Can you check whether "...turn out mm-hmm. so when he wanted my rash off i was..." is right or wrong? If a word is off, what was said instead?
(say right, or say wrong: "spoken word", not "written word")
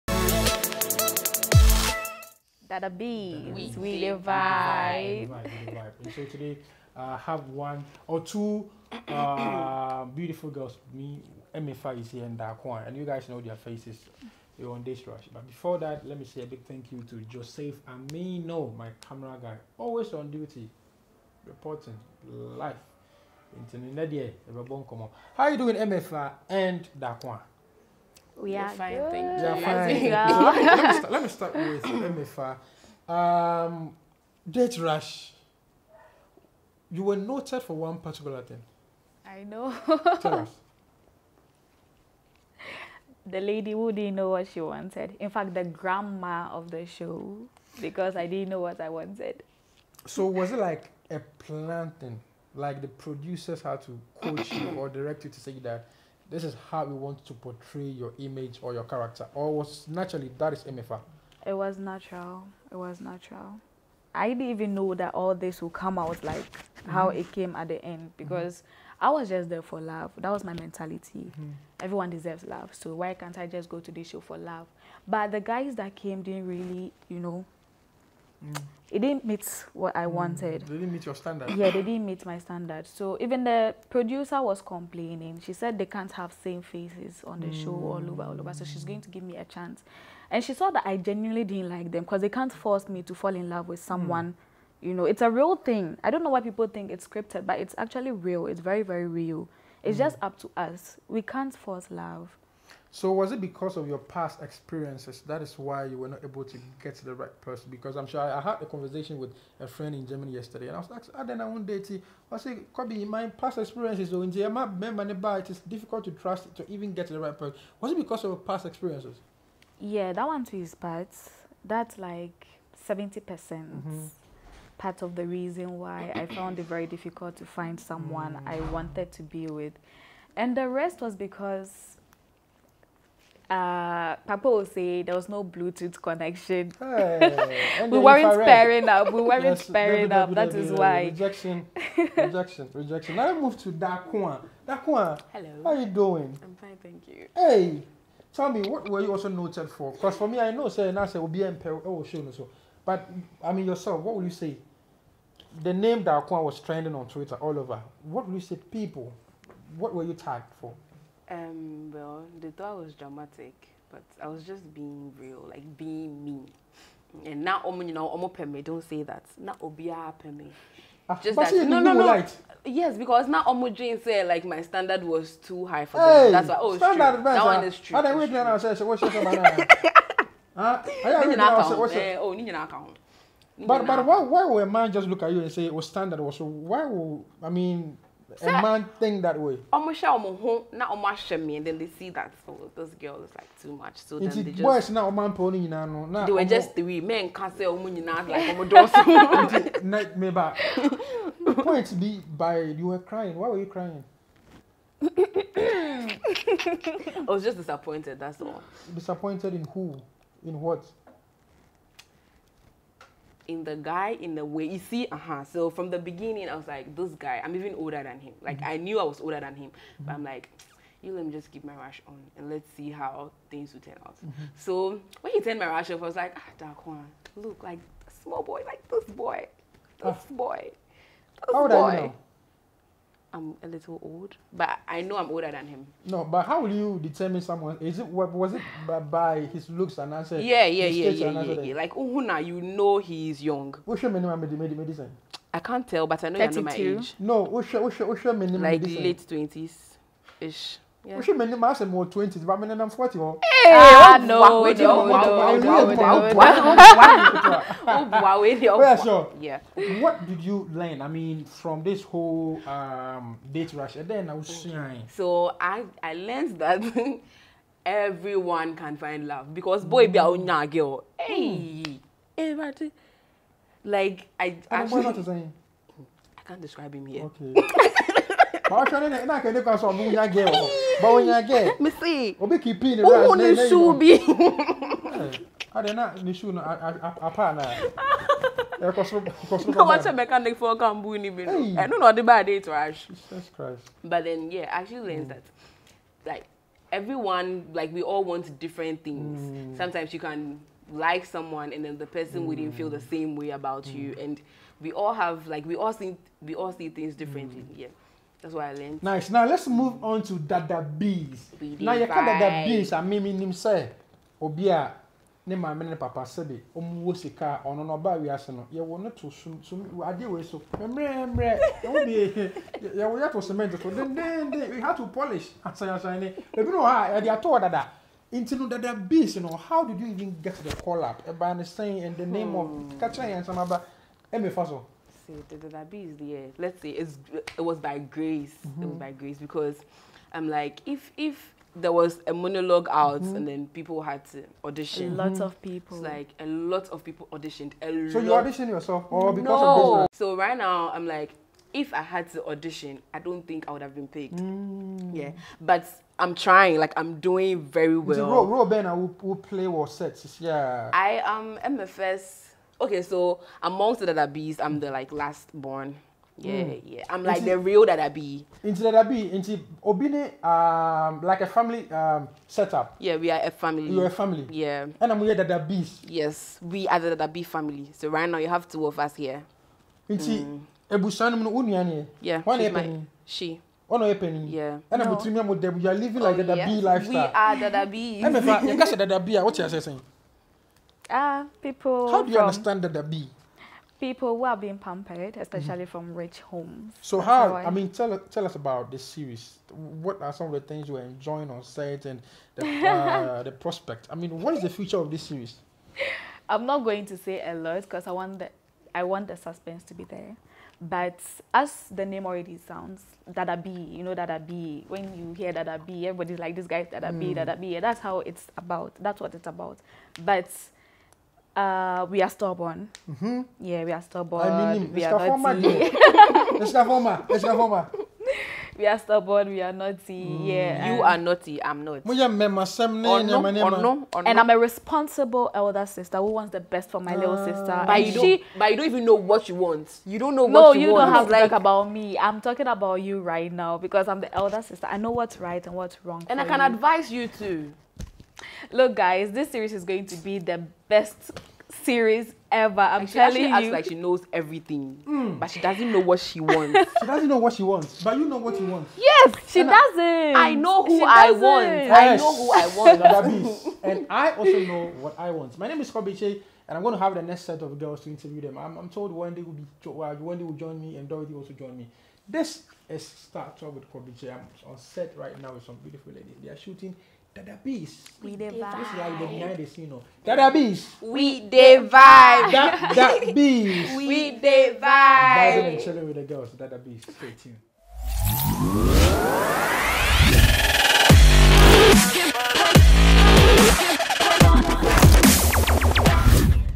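wrong: "turned", not "wanted".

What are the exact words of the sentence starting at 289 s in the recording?
na wakyɛ mechanic fɔ ɔka mbu ni bi no ɛno na ɔde ba ade to ahwe.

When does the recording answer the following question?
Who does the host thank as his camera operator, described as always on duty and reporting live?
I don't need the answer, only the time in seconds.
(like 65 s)
17 s.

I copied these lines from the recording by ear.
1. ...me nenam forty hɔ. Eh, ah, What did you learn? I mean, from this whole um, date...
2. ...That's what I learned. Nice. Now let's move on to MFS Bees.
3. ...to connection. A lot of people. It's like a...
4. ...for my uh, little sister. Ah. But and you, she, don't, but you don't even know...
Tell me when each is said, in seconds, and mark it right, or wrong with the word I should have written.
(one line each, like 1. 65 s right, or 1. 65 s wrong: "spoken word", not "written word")
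1. 252 s right
2. 308 s wrong: "Dada", not "MFS"
3. 344 s wrong: "audition", not "connection"
4. 436 s right.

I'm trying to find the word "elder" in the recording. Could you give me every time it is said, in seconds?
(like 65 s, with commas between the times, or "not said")
435 s, 444 s.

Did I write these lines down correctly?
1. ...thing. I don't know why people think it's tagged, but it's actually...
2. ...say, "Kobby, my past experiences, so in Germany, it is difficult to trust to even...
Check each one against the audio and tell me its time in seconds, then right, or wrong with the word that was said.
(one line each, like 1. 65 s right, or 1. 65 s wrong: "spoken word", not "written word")
1. 95 s wrong: "scripted", not "tagged"
2. 112 s right.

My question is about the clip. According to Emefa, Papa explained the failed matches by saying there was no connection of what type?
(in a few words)
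Bluetooth.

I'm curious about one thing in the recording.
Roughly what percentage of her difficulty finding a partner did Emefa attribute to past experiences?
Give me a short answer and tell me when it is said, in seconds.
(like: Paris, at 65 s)
70 percent, at 122 s.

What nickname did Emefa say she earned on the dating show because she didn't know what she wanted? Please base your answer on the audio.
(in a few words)
the grandma of the show.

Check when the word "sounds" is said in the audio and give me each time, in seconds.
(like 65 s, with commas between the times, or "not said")
412 s.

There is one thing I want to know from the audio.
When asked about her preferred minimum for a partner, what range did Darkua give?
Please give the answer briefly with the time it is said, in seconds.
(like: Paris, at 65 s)
late twenties, at 249 s.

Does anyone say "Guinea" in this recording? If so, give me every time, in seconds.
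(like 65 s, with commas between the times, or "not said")
not said.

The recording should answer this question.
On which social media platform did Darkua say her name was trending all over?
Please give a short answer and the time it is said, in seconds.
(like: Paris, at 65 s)
Twitter, at 157 s.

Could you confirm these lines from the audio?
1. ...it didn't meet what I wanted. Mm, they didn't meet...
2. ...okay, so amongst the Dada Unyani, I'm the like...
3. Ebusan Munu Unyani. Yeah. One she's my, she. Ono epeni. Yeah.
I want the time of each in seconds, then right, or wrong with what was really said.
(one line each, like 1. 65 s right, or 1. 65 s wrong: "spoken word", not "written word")
1. 78 s right
2. 362 s wrong: "Bees", not "Unyani"
3. 380 s right.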